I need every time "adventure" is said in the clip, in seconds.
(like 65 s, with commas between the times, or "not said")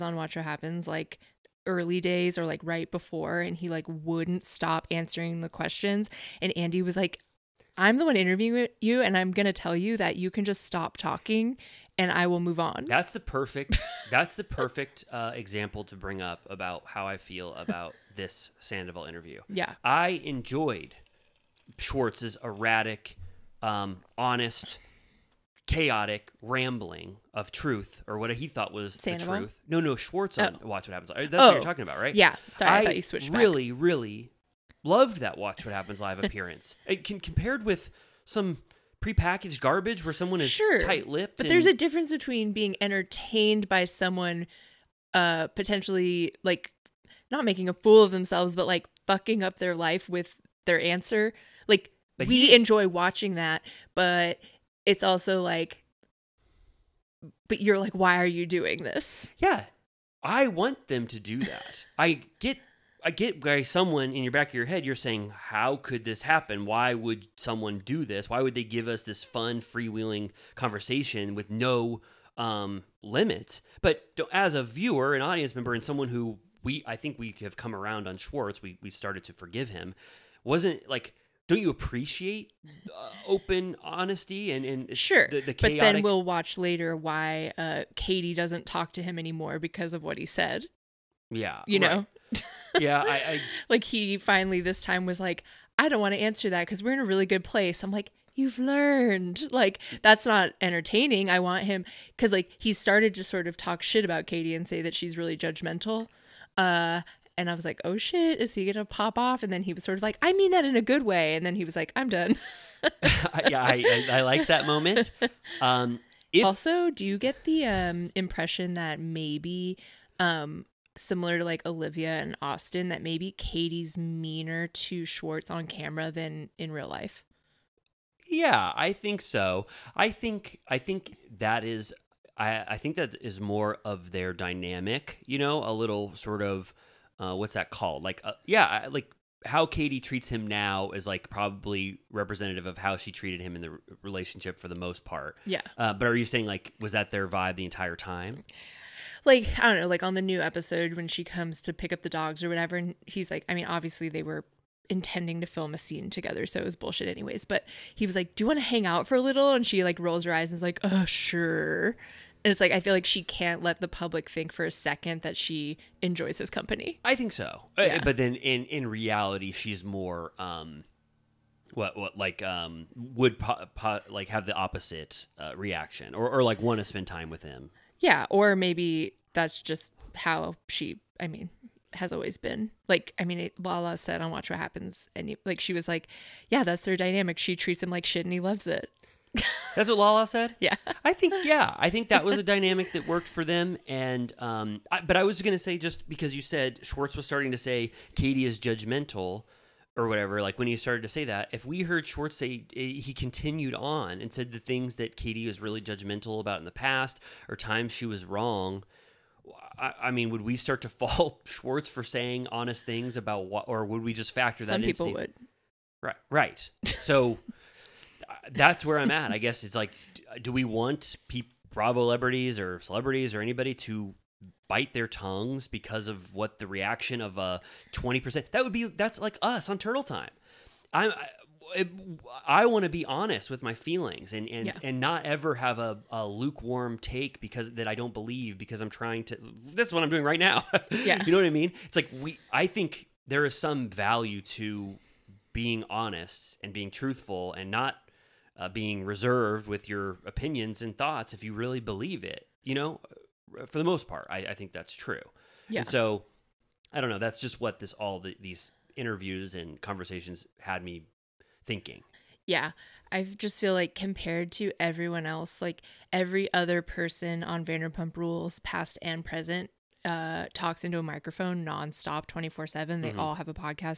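not said.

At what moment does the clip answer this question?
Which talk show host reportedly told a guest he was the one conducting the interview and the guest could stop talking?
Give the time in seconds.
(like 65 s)
6 s.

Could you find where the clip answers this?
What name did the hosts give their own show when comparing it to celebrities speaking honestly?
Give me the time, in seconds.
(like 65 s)
229 s.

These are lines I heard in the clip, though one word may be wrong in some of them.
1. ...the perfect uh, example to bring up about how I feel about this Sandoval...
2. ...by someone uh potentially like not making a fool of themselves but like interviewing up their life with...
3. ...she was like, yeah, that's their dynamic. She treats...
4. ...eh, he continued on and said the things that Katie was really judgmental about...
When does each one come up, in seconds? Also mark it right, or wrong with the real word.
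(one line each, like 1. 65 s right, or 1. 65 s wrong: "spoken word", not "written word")
1. 14 s right
2. 43 s wrong: "fucking", not "interviewing"
3. 185 s right
4. 202 s right.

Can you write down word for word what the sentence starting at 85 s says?
but then we'll watch later why uh, katie doesn't talk to him anymore because of what he said yeah you right.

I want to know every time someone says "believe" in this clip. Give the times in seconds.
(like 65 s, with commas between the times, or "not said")
238 s, 251 s.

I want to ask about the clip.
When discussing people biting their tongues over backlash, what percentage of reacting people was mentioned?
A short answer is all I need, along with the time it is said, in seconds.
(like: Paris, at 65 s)
20%, at 227 s.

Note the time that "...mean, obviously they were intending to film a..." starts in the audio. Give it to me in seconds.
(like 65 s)
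153 s.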